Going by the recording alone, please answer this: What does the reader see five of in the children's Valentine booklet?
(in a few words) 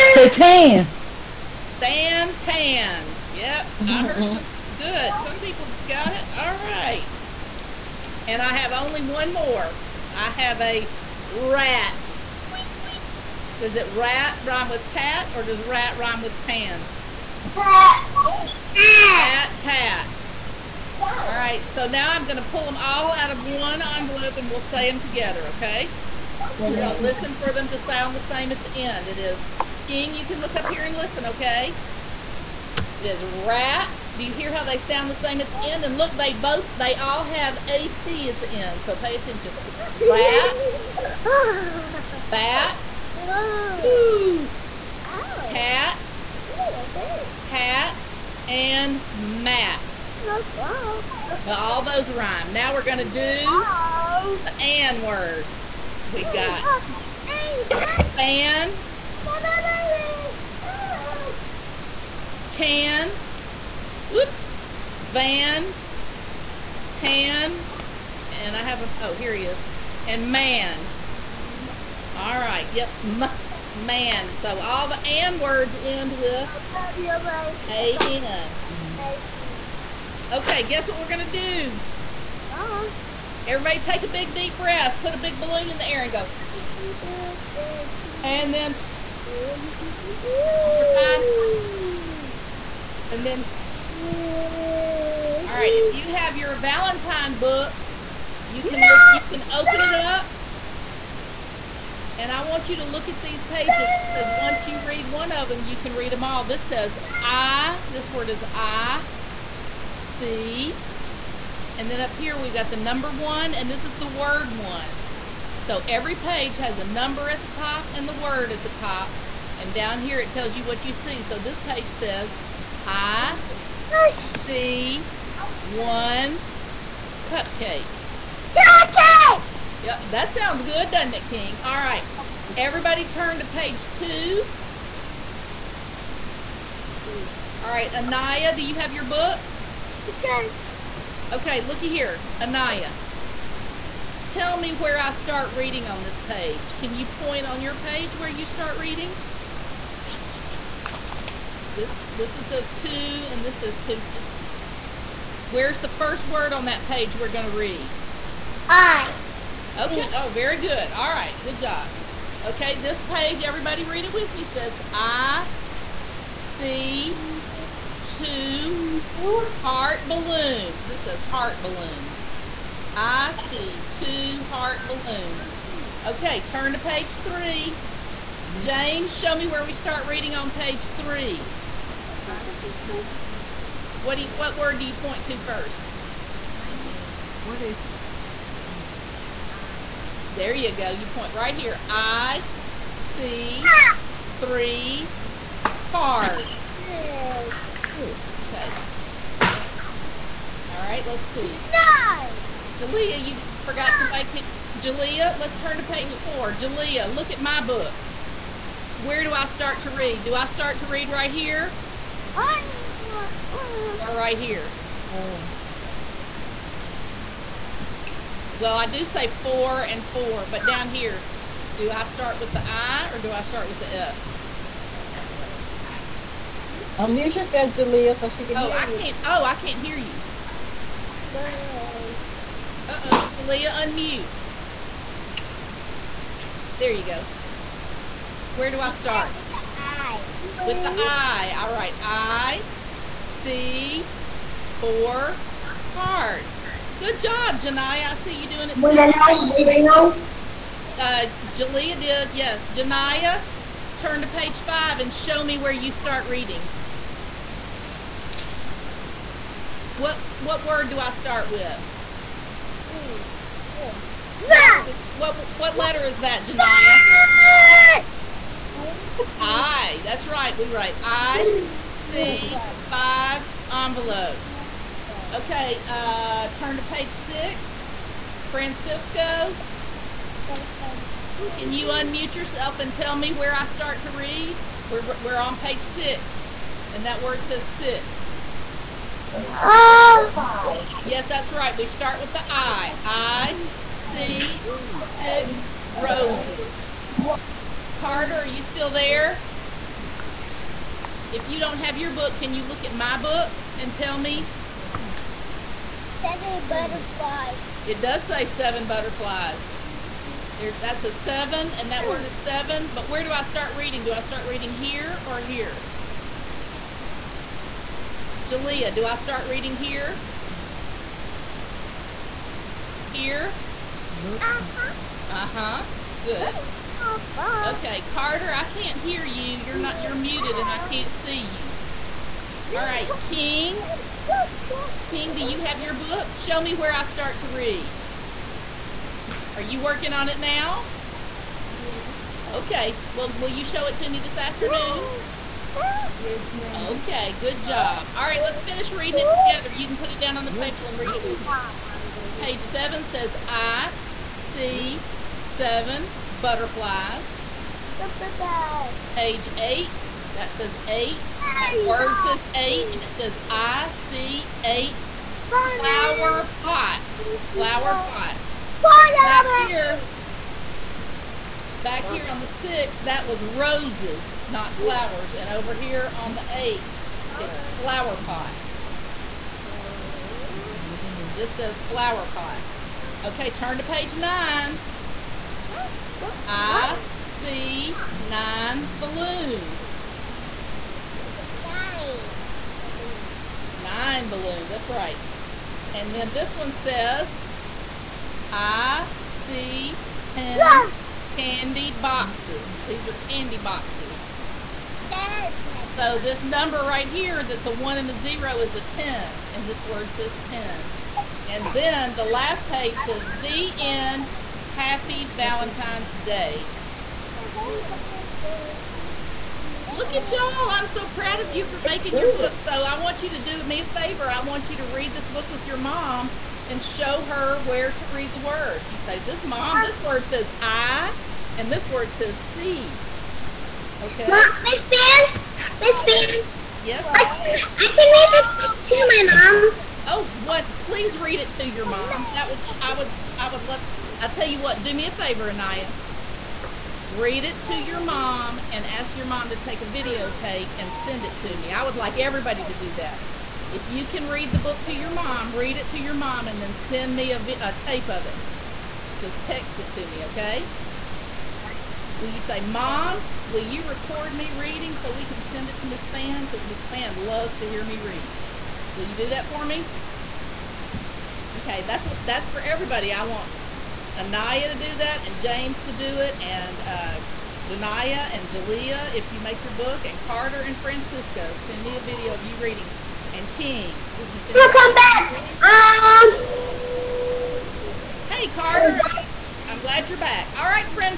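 envelopes.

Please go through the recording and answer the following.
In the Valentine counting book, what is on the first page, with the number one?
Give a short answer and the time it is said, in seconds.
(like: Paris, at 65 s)
one cupcake, at 125 s.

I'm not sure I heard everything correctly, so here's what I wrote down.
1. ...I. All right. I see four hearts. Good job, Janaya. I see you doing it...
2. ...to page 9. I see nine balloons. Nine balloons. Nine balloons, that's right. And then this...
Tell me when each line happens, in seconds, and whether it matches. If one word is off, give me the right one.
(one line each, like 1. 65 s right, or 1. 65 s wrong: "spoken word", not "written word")
1. 240 s right
2. 383 s right.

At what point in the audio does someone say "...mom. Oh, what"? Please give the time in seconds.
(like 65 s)
439 s.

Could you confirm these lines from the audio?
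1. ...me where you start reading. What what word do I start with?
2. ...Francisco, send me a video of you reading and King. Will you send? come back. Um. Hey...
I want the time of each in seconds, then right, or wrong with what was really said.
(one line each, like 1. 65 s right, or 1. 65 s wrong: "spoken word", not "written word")
1. 255 s right
2. 480 s right.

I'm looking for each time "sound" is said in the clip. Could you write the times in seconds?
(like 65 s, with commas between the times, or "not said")
27 s, 34 s, 130 s.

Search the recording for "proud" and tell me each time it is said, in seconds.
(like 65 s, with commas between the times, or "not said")
421 s.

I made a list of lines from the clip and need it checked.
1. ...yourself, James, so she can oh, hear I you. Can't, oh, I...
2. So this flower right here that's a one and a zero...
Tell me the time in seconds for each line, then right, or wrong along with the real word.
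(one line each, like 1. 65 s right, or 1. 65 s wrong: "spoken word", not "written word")
1. 227 s wrong: "Jalea", not "James"
2. 405 s wrong: "number", not "flower".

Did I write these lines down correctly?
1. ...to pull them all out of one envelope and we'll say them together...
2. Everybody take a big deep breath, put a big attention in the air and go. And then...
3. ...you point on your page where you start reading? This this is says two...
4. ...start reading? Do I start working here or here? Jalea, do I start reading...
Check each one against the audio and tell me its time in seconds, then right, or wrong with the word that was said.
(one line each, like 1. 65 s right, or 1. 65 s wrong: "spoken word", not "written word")
1. 22 s right
2. 83 s wrong: "balloon", not "attention"
3. 146 s right
4. 313 s wrong: "reading", not "working".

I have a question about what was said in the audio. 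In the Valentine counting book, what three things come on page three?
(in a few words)
cards.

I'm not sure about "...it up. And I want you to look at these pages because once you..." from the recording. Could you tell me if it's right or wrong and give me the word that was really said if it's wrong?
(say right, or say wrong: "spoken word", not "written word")
right.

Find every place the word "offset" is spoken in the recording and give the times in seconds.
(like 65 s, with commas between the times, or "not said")
not said.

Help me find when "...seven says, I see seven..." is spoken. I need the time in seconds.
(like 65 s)
352 s.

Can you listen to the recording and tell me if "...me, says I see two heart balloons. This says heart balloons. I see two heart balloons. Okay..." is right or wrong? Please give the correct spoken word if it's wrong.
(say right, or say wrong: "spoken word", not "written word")
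right.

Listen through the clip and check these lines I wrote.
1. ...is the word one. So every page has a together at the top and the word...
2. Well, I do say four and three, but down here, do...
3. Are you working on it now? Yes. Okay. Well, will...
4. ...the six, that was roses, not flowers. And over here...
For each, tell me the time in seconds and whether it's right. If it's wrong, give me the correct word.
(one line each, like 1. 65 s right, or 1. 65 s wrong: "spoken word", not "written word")
1. 113 s wrong: "number", not "together"
2. 218 s wrong: "four", not "three"
3. 339 s right
4. 372 s right.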